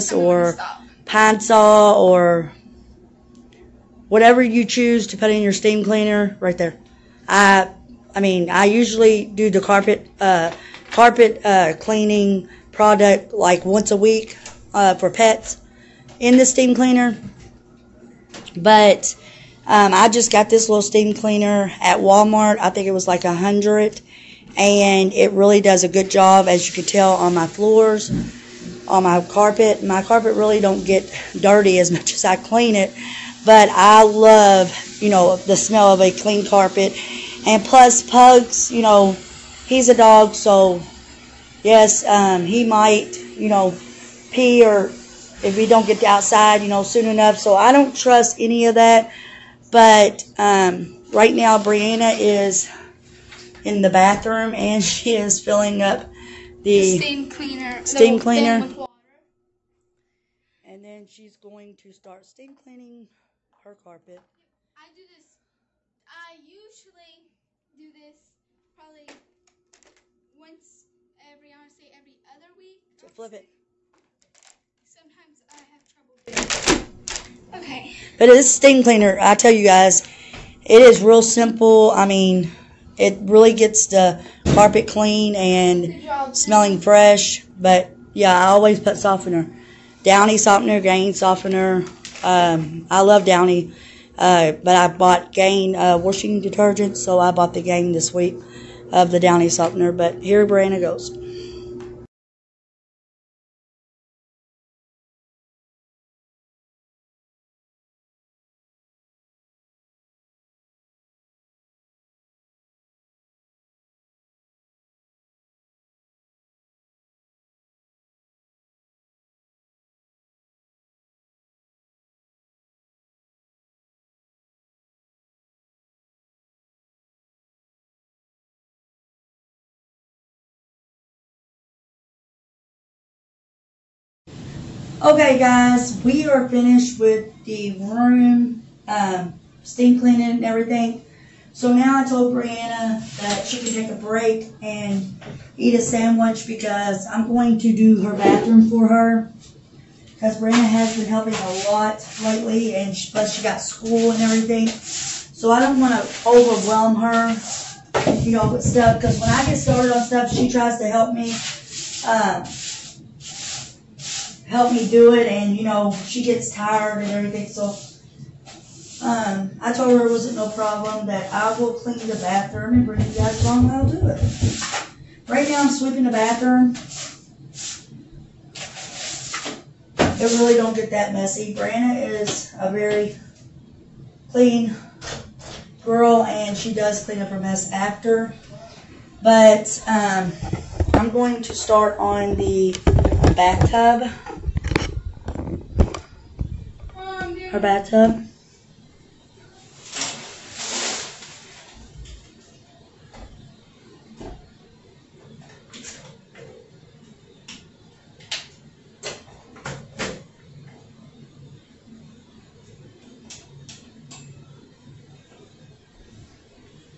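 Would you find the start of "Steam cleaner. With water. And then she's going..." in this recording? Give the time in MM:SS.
00:57.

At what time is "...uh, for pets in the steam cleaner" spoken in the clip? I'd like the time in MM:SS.
00:14.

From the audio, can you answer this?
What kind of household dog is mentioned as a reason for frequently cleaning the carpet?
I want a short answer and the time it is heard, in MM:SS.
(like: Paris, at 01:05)
Pugs, at 00:38.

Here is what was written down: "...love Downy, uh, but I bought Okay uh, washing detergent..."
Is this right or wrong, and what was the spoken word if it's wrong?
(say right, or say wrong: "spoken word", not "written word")
wrong: "Gain", not "Okay".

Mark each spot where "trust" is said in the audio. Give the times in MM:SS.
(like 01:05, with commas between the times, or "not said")
00:47.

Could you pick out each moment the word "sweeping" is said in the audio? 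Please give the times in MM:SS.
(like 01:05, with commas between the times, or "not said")
02:55.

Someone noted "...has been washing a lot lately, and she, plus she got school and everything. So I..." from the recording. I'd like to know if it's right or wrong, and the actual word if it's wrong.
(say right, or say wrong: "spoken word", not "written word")
wrong: "helping", not "washing".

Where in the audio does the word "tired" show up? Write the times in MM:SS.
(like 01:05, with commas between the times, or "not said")
02:46.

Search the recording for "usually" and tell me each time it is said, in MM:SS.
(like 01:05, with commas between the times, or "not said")
00:08, 01:06.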